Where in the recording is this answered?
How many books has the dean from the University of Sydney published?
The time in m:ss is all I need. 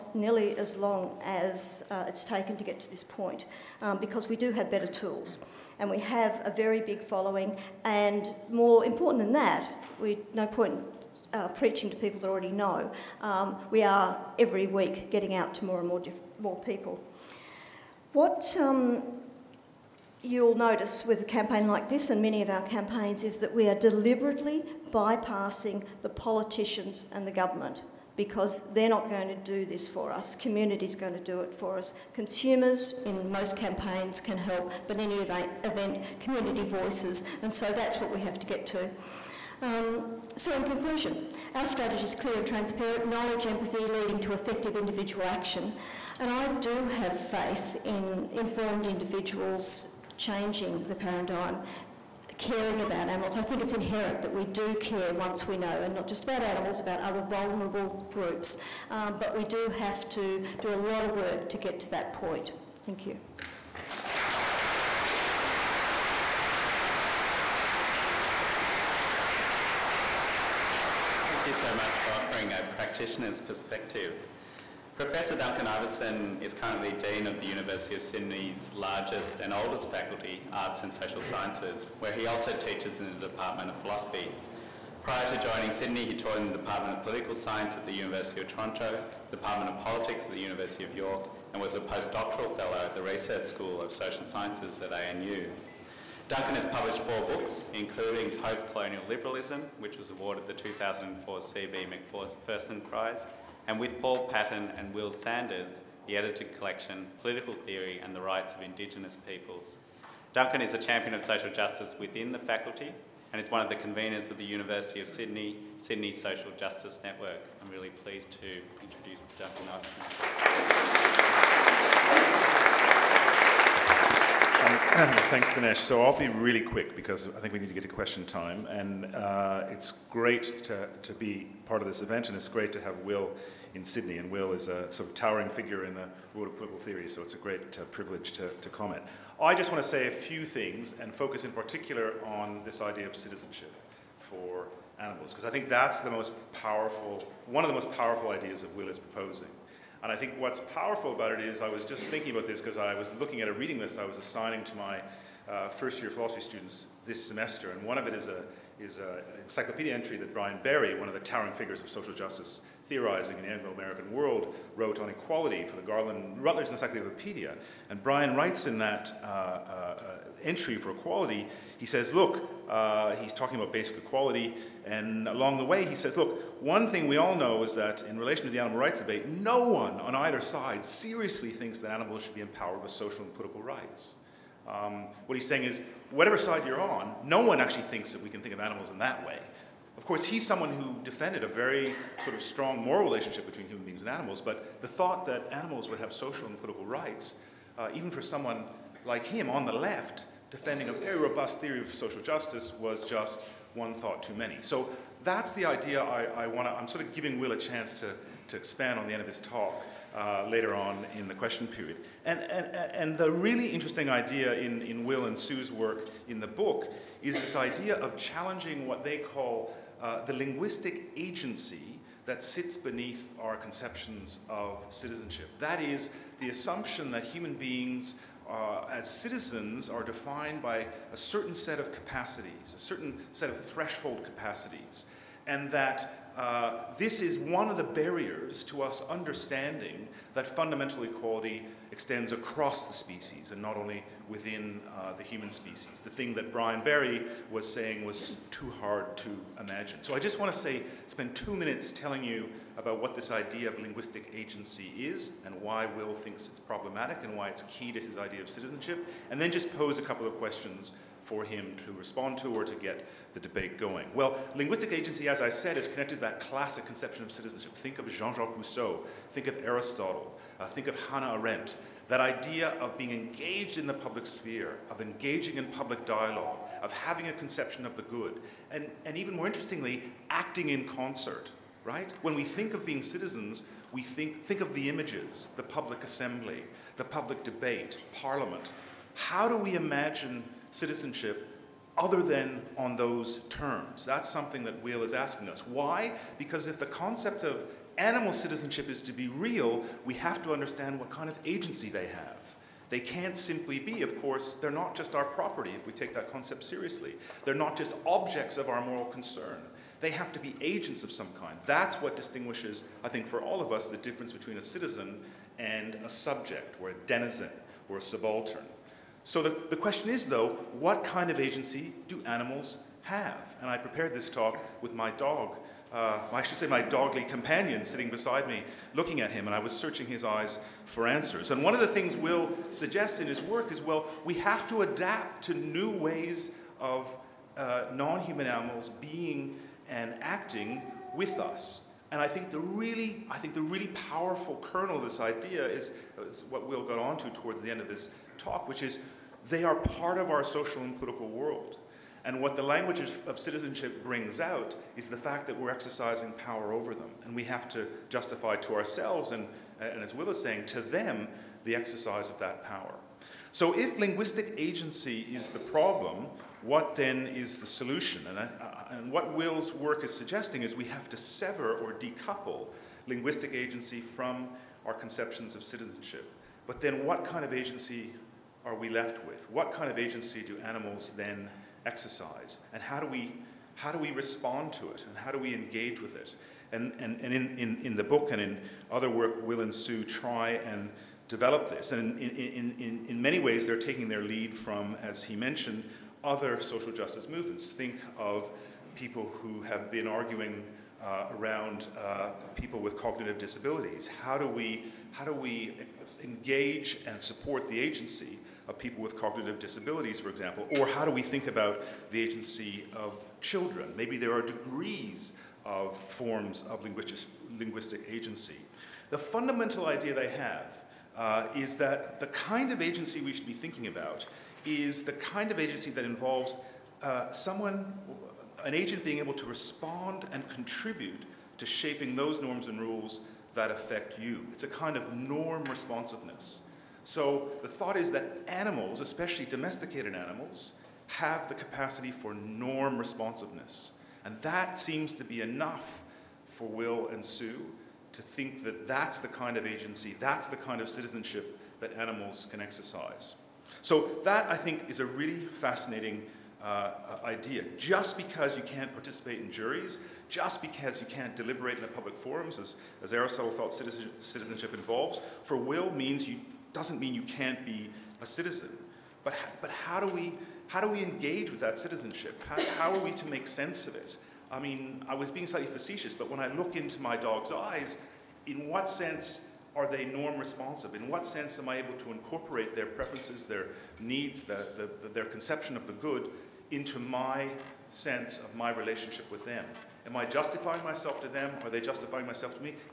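1:36.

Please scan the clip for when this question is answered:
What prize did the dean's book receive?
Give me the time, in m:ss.
1:41.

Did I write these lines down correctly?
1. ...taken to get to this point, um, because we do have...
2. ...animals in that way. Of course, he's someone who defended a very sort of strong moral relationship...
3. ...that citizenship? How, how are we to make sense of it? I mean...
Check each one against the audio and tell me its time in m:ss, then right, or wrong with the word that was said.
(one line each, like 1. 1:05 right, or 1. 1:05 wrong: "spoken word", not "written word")
1. 0:02 right
2. 3:08 right
3. 7:51 right.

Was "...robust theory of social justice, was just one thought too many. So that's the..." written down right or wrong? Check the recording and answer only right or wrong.
right.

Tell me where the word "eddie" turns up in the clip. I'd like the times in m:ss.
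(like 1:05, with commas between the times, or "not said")
not said.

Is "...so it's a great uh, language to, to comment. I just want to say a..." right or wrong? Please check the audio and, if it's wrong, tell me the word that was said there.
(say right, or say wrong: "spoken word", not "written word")
wrong: "privilege", not "language".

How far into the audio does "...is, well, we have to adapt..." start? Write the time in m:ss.
5:33.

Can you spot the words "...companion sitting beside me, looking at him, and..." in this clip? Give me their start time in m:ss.
5:27.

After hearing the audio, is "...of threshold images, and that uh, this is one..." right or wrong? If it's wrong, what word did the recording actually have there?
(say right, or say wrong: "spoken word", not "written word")
wrong: "capacities", not "images".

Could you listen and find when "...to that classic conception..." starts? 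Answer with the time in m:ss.
4:26.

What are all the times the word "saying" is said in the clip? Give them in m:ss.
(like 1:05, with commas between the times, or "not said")
3:05, 4:07, 6:00.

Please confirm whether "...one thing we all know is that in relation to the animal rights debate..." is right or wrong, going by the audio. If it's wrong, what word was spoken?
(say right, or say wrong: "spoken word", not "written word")
right.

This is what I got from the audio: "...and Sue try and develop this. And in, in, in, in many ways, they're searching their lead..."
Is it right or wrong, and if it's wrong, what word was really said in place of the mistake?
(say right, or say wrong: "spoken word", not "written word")
wrong: "taking", not "searching".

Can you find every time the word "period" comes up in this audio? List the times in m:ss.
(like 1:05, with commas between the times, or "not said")
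3:31.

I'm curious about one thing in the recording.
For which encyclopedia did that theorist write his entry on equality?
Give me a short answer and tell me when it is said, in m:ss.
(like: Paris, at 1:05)
Garland Routledge Encyclopedia, at 2:45.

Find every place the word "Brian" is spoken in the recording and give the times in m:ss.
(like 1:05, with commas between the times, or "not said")
2:40, 2:48, 4:06.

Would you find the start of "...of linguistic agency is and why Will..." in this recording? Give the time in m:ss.
4:13.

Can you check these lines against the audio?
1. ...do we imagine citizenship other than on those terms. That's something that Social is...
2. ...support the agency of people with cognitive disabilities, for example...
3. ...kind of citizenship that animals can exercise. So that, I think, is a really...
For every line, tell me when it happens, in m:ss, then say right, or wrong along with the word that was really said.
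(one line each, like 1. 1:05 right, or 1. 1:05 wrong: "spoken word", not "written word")
1. 4:49 wrong: "Will", not "Social"
2. 6:47 right
3. 7:30 right.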